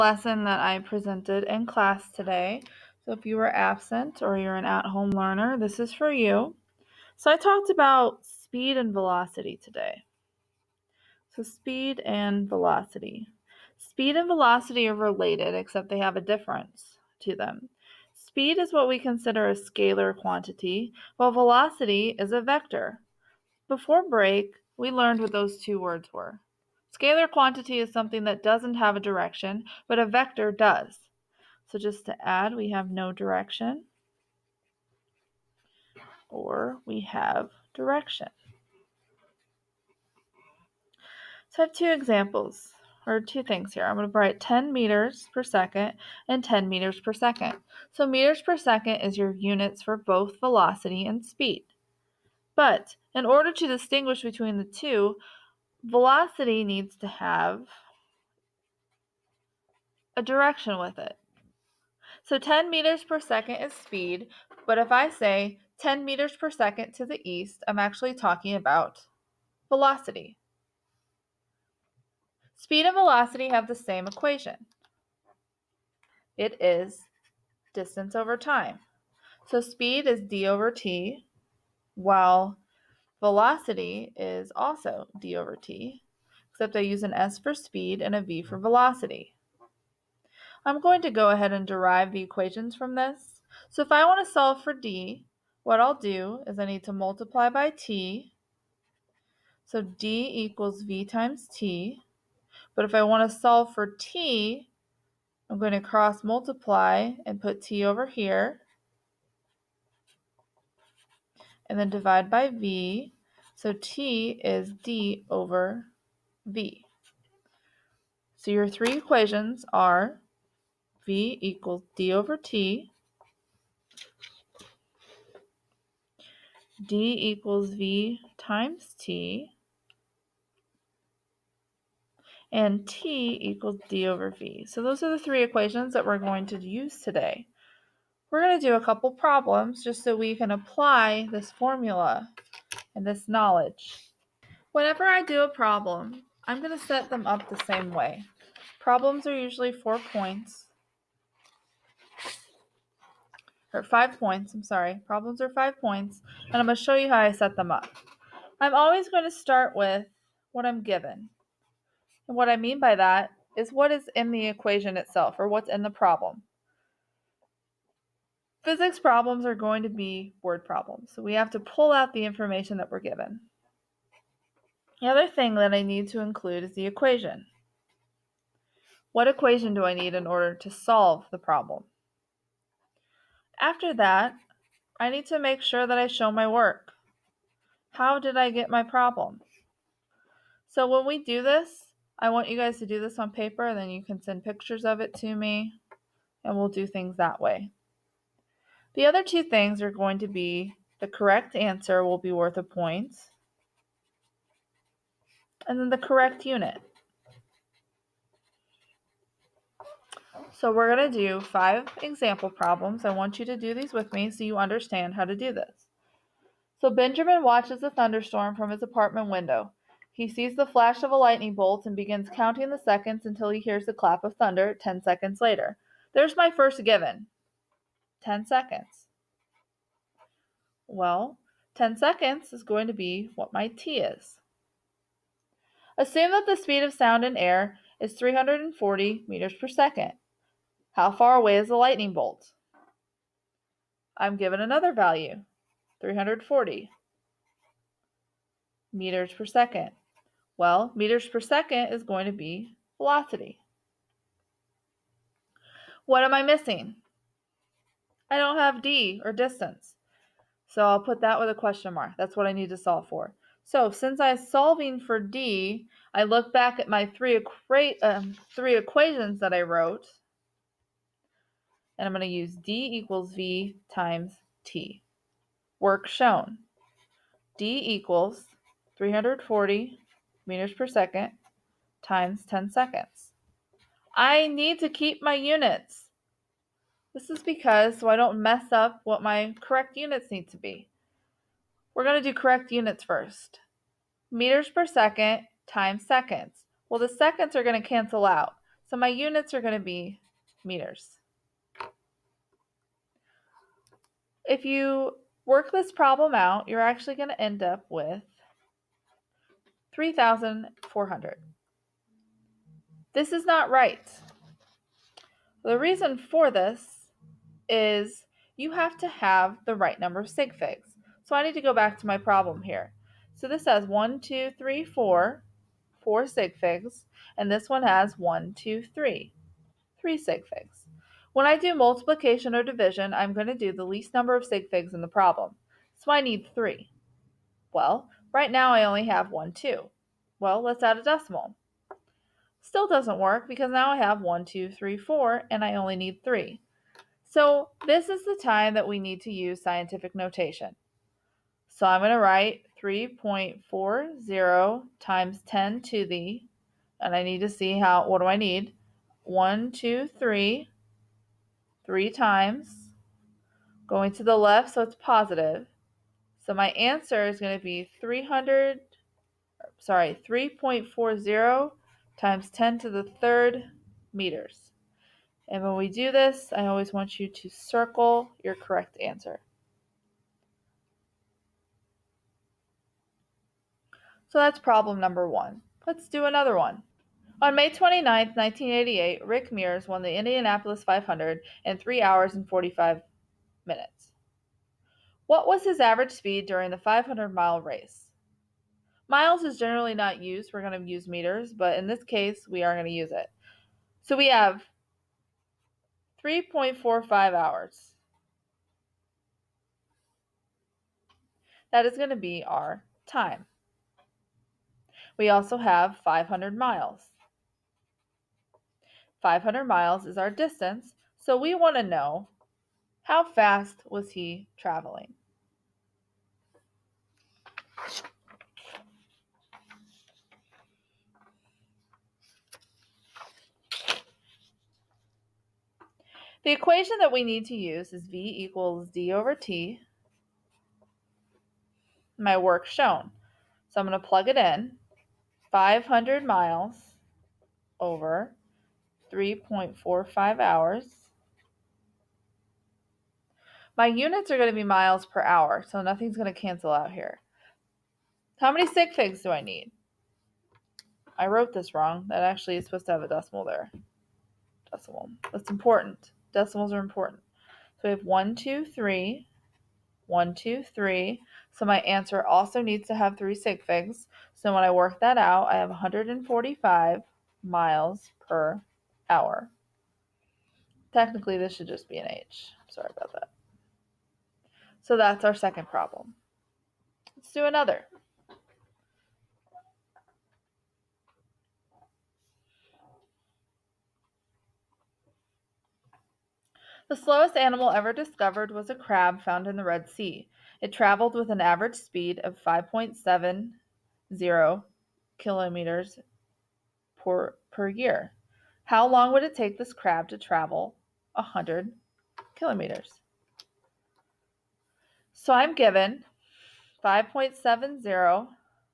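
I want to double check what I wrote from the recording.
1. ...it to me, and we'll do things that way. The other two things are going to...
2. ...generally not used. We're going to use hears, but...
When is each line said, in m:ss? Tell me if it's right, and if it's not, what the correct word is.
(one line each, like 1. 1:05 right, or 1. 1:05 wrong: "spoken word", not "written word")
1. 3:15 right
2. 6:39 wrong: "meters", not "hears".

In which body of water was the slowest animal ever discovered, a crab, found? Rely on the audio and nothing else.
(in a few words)
Red Sea.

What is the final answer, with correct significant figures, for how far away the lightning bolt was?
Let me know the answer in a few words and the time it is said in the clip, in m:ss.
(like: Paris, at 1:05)
3.40 x 10^3 meters, at 6:10.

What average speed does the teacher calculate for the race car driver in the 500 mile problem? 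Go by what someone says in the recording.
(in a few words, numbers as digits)
145 miles per hour.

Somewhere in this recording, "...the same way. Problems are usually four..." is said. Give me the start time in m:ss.
2:27.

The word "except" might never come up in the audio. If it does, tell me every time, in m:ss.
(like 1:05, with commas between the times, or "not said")
0:15, 1:26.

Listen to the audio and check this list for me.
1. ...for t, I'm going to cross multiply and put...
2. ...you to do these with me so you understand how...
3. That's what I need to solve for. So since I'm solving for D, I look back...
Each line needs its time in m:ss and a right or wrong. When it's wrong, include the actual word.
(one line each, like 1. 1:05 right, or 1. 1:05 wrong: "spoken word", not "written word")
1. 1:43 right
2. 3:33 right
3. 4:22 right.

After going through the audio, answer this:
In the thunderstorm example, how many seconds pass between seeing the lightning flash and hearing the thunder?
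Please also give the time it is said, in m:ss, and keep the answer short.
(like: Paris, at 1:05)
10 seconds, at 3:44.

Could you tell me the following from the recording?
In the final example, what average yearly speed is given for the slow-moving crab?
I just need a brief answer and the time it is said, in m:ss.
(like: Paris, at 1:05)
5.70 kilometers per year, at 8:22.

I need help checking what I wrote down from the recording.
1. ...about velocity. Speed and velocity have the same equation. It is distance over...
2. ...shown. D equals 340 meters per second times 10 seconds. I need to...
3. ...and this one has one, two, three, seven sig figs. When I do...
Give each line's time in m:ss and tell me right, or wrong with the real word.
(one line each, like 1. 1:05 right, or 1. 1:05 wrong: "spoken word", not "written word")
1. 1:08 right
2. 4:36 right
3. 5:27 wrong: "three", not "seven".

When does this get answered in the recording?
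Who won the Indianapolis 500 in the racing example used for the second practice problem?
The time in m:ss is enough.
6:29.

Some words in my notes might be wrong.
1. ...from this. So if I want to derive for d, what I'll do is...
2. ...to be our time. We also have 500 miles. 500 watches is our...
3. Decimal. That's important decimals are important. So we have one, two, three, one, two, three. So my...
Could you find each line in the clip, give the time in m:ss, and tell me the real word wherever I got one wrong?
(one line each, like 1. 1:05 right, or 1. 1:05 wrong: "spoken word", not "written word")
1. 1:32 wrong: "solve", not "derive"
2. 6:52 wrong: "miles", not "watches"
3. 7:44 right.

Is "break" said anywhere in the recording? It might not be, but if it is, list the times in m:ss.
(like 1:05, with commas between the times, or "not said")
0:24.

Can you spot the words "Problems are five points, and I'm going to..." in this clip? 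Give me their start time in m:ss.
2:35.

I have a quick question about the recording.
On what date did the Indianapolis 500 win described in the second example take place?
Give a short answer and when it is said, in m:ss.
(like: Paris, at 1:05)
May 29, 1988, at 6:27.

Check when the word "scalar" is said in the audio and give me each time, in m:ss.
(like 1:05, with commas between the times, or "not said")
0:19, 0:26.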